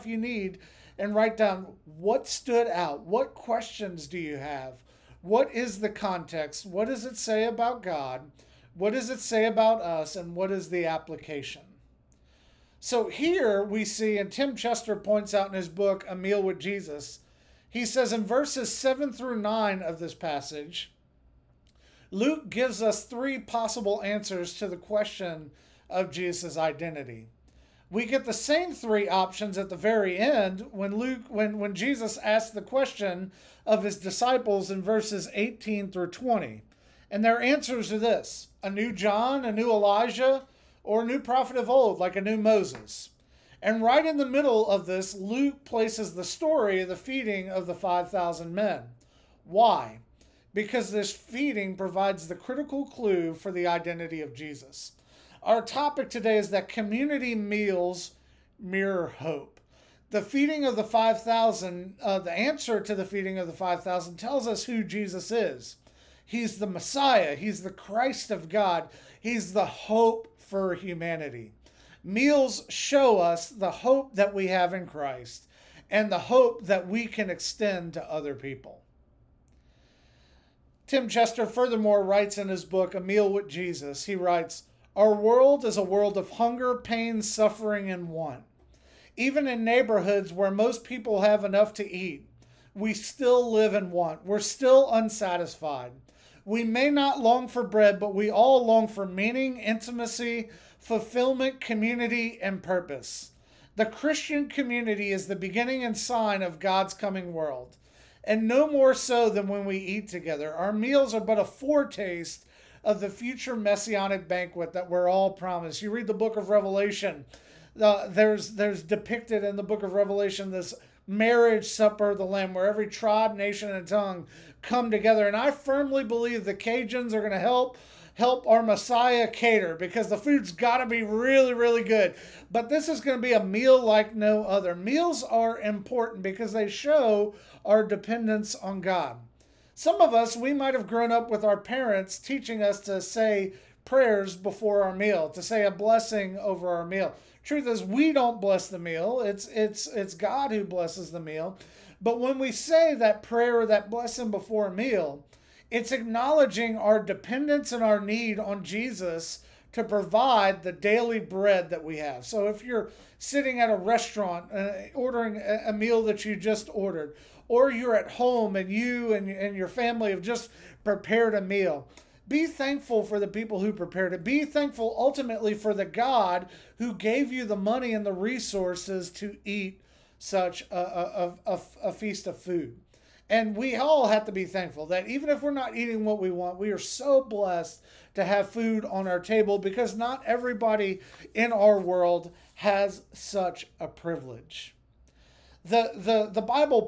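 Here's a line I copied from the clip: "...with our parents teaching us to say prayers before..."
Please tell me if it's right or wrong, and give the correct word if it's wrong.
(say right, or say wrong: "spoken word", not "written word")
right.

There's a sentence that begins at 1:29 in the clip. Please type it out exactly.
Even in neighborhoods where most people have enough to eat, we still live in want.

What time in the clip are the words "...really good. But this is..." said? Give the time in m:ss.
2:11.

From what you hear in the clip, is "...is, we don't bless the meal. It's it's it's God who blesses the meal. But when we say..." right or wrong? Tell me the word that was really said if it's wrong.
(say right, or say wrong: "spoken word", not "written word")
right.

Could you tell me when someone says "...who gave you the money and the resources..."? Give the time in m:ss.
2:56.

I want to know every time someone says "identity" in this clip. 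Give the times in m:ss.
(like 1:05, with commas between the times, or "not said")
0:26, 0:53.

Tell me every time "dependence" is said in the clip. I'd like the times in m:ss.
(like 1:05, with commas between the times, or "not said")
2:17, 2:36.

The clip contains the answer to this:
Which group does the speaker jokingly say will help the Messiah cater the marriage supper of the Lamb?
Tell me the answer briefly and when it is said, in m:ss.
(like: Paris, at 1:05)
The Cajuns, at 2:06.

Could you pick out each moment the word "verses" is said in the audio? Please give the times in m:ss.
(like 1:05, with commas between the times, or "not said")
0:18, 0:34.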